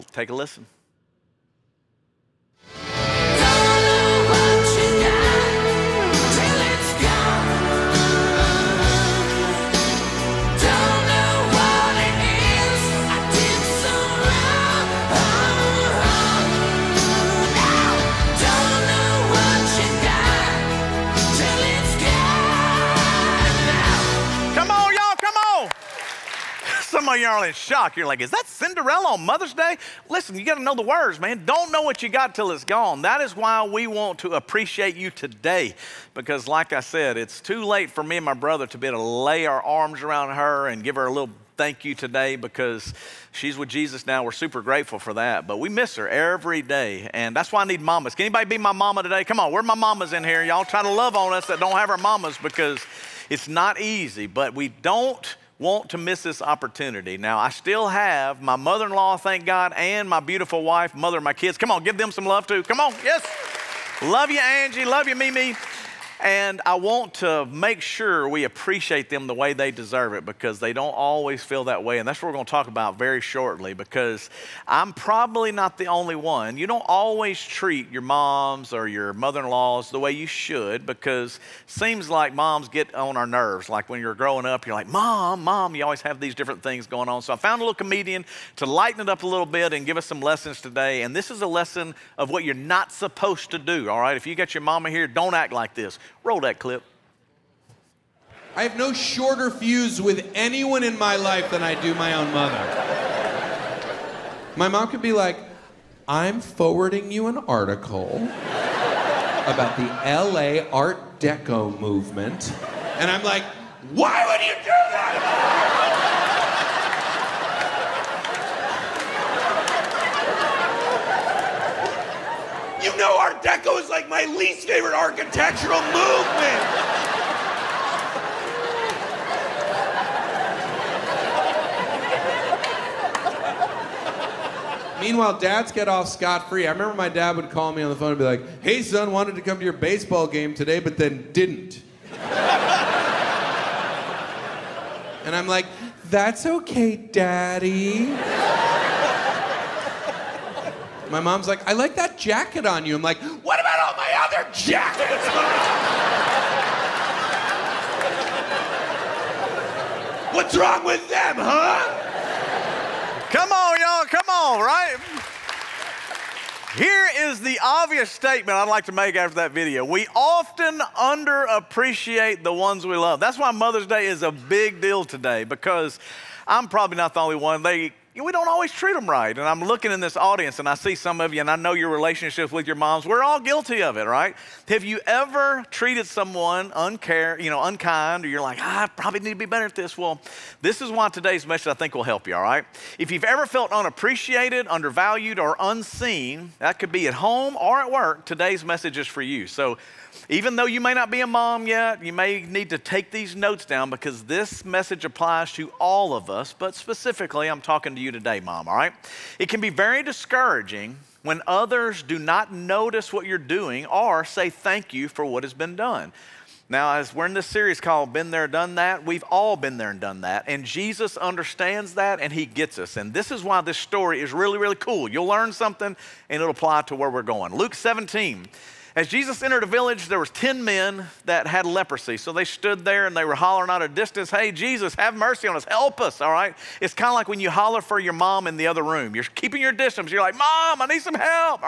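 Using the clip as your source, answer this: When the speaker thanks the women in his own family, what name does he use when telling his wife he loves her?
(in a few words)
Angie.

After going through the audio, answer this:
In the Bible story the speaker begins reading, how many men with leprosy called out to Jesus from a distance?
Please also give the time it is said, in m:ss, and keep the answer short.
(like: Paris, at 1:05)
10, at 3:50.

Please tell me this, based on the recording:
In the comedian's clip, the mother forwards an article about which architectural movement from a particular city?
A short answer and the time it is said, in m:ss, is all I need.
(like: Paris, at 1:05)
LA Art Deco movement, at 1:49.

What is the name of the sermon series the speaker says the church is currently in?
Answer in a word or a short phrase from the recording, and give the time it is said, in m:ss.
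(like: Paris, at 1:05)
Been There, Done That, at 3:38.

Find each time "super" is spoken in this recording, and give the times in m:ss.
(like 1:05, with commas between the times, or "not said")
0:44.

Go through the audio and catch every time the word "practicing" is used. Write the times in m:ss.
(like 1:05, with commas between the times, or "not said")
not said.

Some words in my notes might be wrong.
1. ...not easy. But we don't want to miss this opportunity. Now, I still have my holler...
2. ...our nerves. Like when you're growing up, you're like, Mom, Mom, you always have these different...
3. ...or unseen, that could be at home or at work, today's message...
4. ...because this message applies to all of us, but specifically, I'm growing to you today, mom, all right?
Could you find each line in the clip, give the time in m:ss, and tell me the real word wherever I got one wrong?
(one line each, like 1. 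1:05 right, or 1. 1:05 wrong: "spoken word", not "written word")
1. 0:53 wrong: "mother", not "holler"
2. 1:23 right
3. 3:15 right
4. 3:23 wrong: "talking", not "growing".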